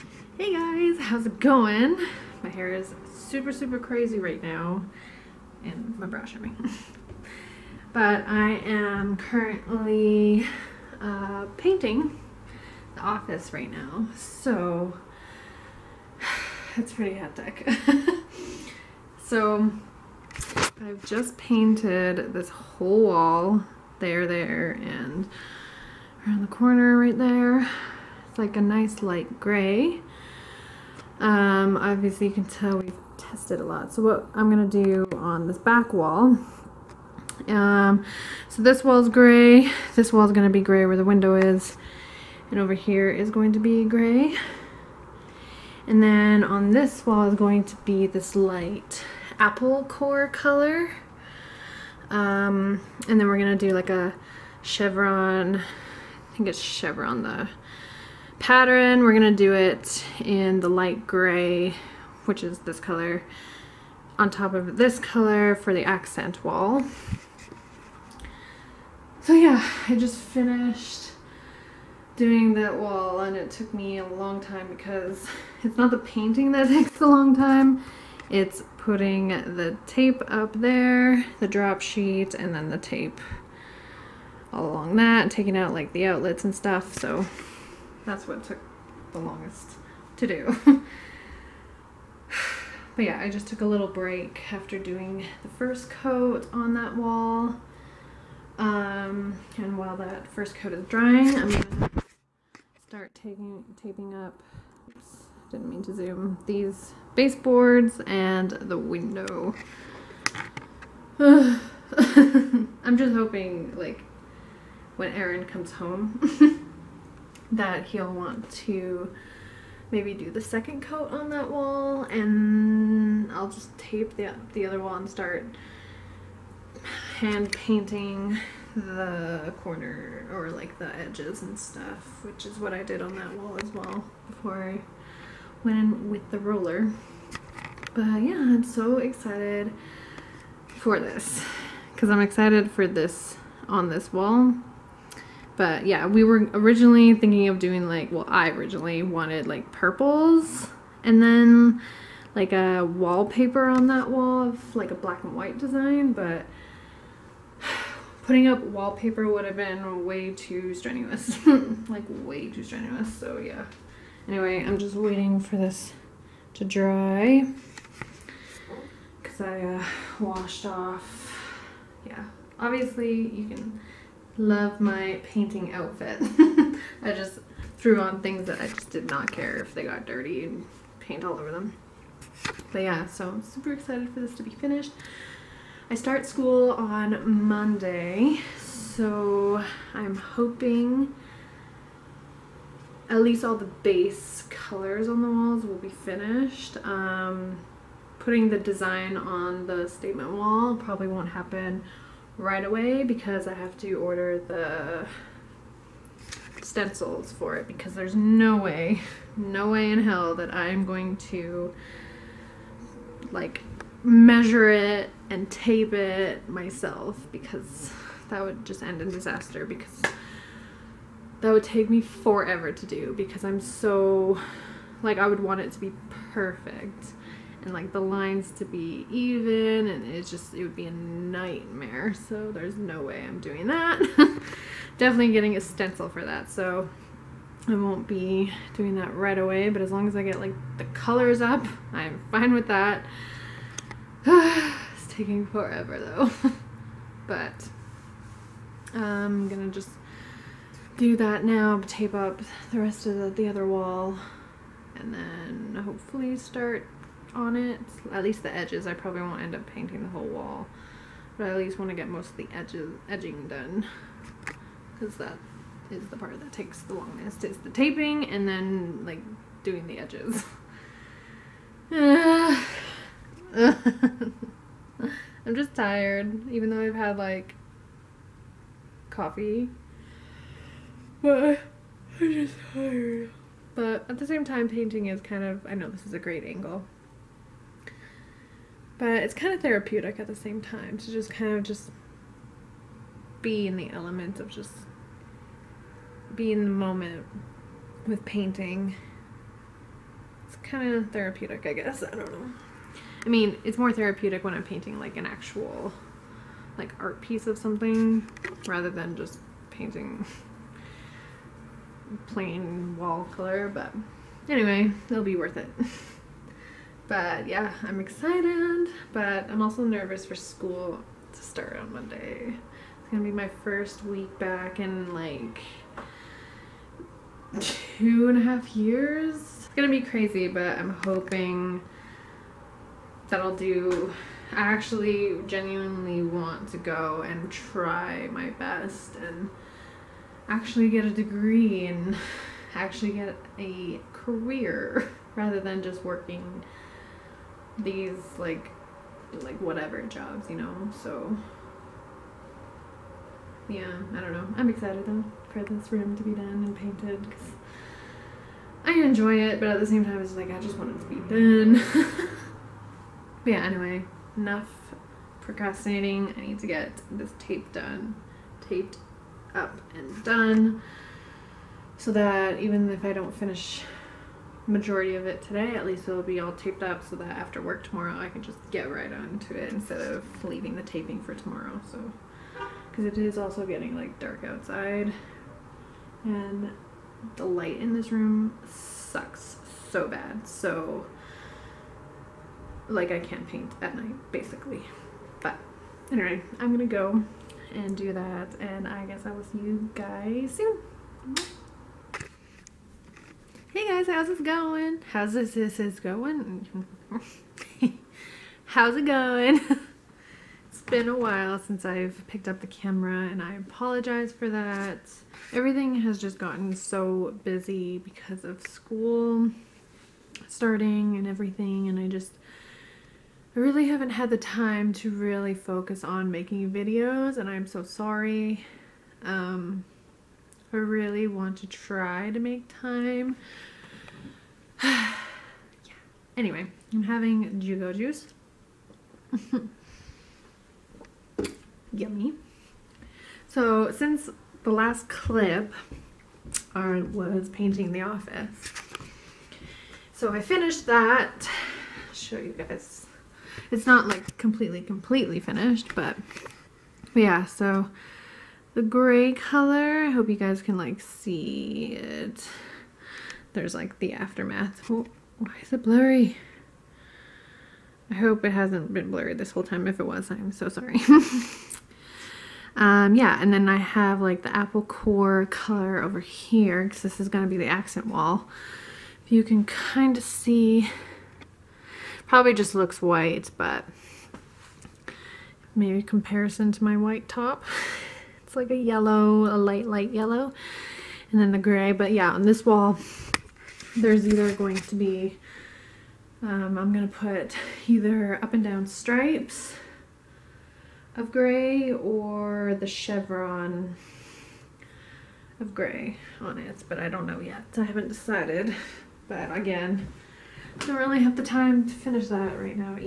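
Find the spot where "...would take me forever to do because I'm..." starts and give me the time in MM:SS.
03:41.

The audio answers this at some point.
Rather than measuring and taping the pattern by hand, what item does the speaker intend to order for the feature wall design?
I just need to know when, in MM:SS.
03:26.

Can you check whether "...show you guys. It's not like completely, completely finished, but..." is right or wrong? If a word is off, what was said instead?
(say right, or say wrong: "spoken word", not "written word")
right.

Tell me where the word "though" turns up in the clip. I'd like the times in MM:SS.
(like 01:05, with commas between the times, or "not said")
04:05, 04:36, 05:55.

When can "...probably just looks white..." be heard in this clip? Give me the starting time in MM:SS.
08:02.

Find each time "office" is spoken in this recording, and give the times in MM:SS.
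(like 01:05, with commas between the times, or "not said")
00:13, 07:28.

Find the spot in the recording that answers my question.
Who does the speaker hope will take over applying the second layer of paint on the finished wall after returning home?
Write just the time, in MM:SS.
01:55.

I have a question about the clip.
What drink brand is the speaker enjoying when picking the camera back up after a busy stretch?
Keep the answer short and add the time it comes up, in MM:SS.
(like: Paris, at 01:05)
Jugo Juice, at 07:17.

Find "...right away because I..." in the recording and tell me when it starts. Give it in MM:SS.
03:22.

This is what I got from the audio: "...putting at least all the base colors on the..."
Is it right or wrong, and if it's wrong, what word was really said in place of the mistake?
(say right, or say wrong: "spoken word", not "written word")
wrong: "hoping", not "putting".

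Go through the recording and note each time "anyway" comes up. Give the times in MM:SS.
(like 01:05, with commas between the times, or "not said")
02:44, 05:14, 06:03, 06:36, 07:16.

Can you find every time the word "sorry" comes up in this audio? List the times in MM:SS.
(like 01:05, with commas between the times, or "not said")
07:07, 07:50.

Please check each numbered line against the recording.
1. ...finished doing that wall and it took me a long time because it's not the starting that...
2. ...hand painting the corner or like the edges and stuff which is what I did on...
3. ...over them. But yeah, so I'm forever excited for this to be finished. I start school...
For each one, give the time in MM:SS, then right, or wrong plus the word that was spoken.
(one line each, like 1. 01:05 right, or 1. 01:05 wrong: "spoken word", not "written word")
1. 01:10 wrong: "painting", not "starting"
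2. 02:07 right
3. 03:01 wrong: "super", not "forever".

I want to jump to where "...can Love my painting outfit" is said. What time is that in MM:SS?
02:53.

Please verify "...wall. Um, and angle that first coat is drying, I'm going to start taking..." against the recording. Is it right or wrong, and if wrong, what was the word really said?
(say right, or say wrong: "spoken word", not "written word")
wrong: "while", not "angle".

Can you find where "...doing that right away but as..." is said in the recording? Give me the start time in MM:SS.
03:58.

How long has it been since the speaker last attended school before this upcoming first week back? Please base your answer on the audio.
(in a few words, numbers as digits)
two and a half years.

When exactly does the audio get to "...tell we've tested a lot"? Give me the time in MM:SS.
00:32.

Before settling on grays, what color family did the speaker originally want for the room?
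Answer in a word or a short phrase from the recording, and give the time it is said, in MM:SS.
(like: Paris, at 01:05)
purples, at 02:29.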